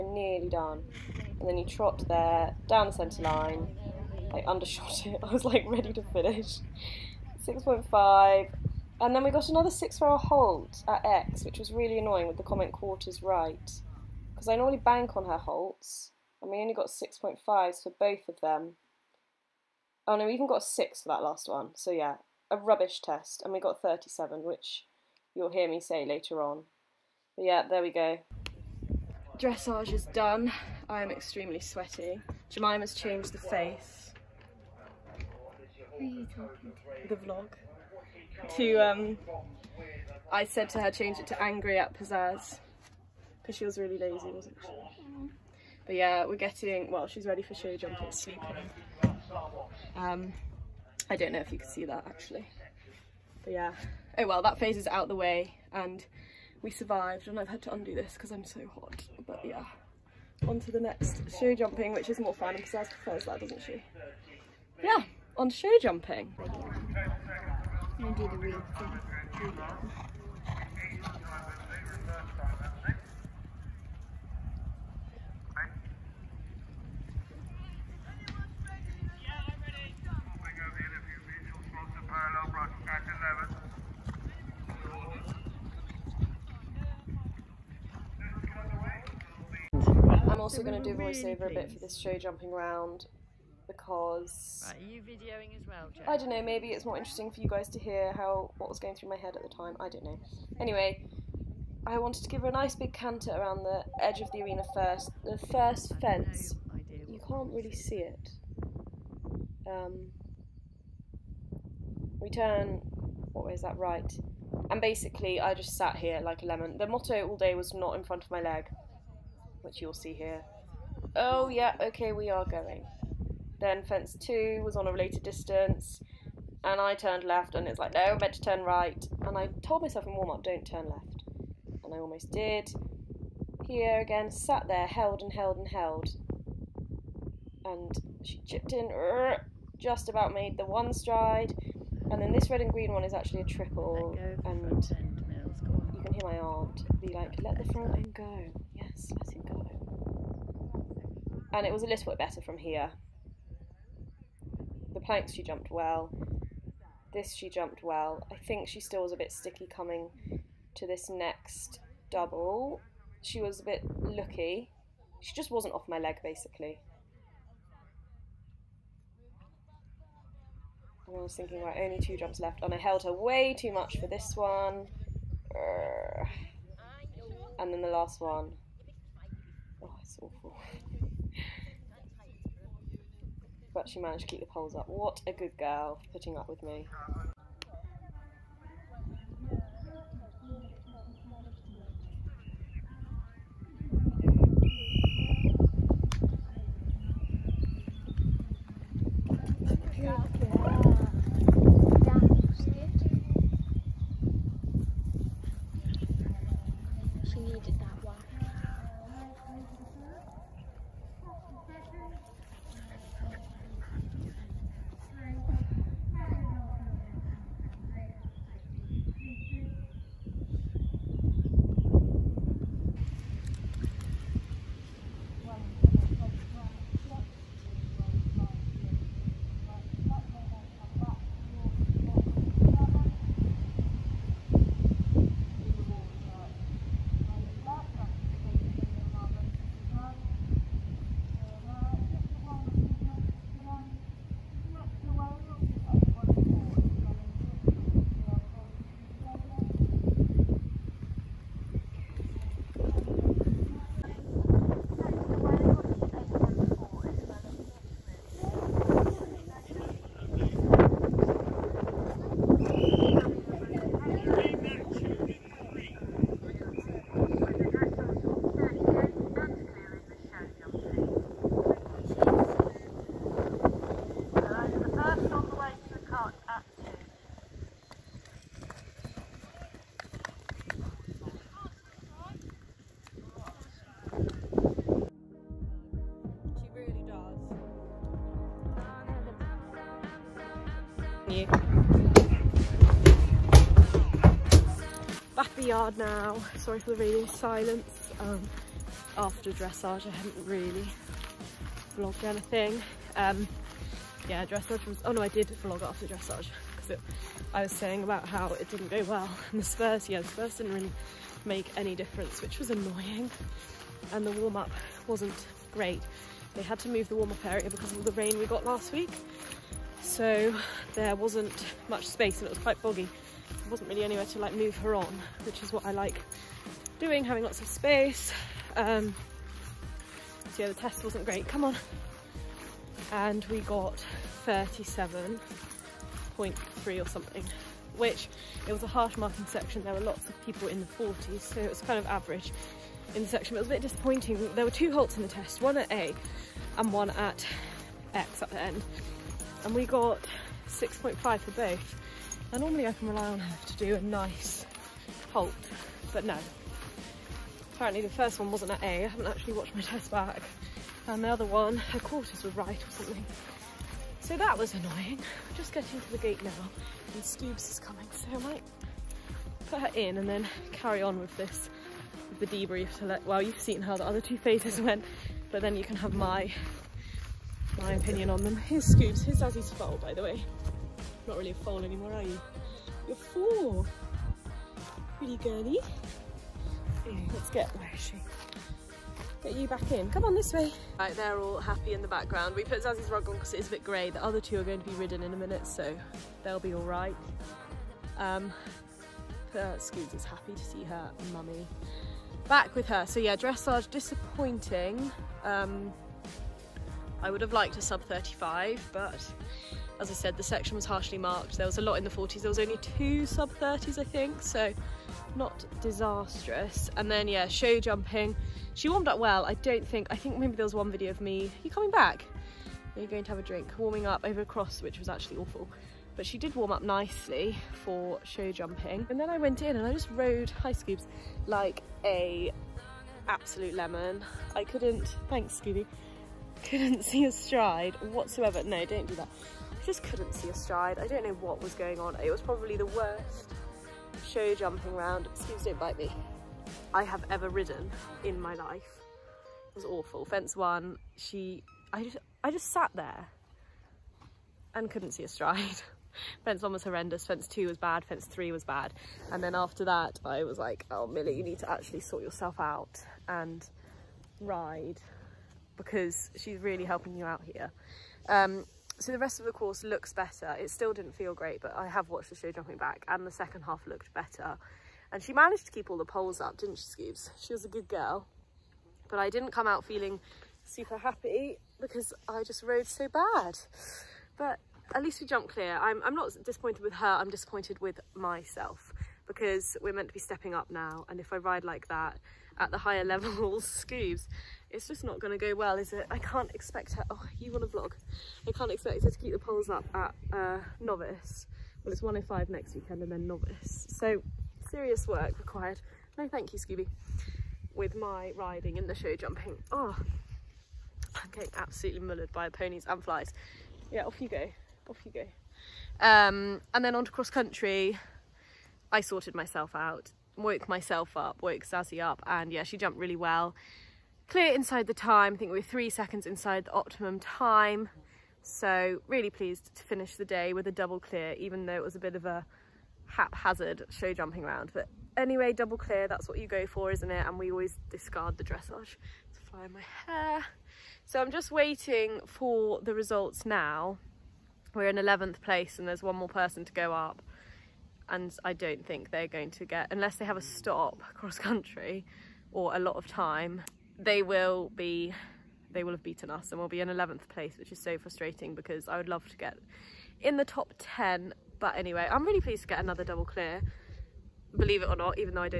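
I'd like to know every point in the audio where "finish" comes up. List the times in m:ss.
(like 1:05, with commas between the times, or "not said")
0:06, 8:49.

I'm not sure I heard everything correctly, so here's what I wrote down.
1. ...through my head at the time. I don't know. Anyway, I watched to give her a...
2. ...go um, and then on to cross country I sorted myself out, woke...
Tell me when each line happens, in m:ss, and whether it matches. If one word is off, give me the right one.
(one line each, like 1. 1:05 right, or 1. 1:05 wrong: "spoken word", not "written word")
1. 1:38 wrong: "wanted", not "watched"
2. 8:35 right.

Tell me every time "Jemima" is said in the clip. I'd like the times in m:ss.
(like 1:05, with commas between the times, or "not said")
0:32.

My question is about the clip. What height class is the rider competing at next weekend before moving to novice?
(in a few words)
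105.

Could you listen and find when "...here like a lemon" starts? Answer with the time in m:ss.
1:55.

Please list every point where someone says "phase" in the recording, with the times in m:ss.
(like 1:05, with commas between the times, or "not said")
0:54, 6:14.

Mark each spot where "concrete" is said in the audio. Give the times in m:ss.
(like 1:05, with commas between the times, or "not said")
not said.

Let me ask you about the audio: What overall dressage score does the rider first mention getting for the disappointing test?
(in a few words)
37.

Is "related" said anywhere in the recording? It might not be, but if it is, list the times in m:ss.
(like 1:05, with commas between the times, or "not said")
2:04.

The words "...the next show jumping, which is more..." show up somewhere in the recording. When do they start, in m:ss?
1:00.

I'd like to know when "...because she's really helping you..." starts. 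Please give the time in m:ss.
7:45.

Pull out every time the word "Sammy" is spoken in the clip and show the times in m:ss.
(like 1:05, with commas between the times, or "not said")
not said.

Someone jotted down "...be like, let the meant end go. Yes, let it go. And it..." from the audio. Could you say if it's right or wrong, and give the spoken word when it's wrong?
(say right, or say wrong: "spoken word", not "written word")
wrong: "front", not "meant".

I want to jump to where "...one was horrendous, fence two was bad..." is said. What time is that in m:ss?
7:36.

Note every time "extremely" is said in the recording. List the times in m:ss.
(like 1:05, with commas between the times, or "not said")
0:31.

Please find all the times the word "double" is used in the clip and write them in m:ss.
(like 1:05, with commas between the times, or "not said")
2:42, 8:50, 8:55, 9:23.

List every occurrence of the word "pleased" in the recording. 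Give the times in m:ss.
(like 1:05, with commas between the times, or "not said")
8:49, 9:22.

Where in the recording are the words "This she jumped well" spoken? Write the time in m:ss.
2:37.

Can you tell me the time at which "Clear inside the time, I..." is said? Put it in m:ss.
8:44.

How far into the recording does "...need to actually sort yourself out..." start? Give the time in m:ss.
7:41.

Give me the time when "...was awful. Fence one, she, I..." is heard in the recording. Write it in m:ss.
7:29.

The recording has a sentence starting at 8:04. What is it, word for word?
But at least we jumped clear.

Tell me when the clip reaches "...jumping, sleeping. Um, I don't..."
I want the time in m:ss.
0:47.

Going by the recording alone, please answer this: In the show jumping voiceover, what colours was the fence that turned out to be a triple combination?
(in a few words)
red and green.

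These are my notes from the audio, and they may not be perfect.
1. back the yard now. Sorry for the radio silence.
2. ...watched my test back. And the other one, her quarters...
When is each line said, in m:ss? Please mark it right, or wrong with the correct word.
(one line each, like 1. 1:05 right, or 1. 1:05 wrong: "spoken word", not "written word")
1. 4:55 right
2. 5:59 right.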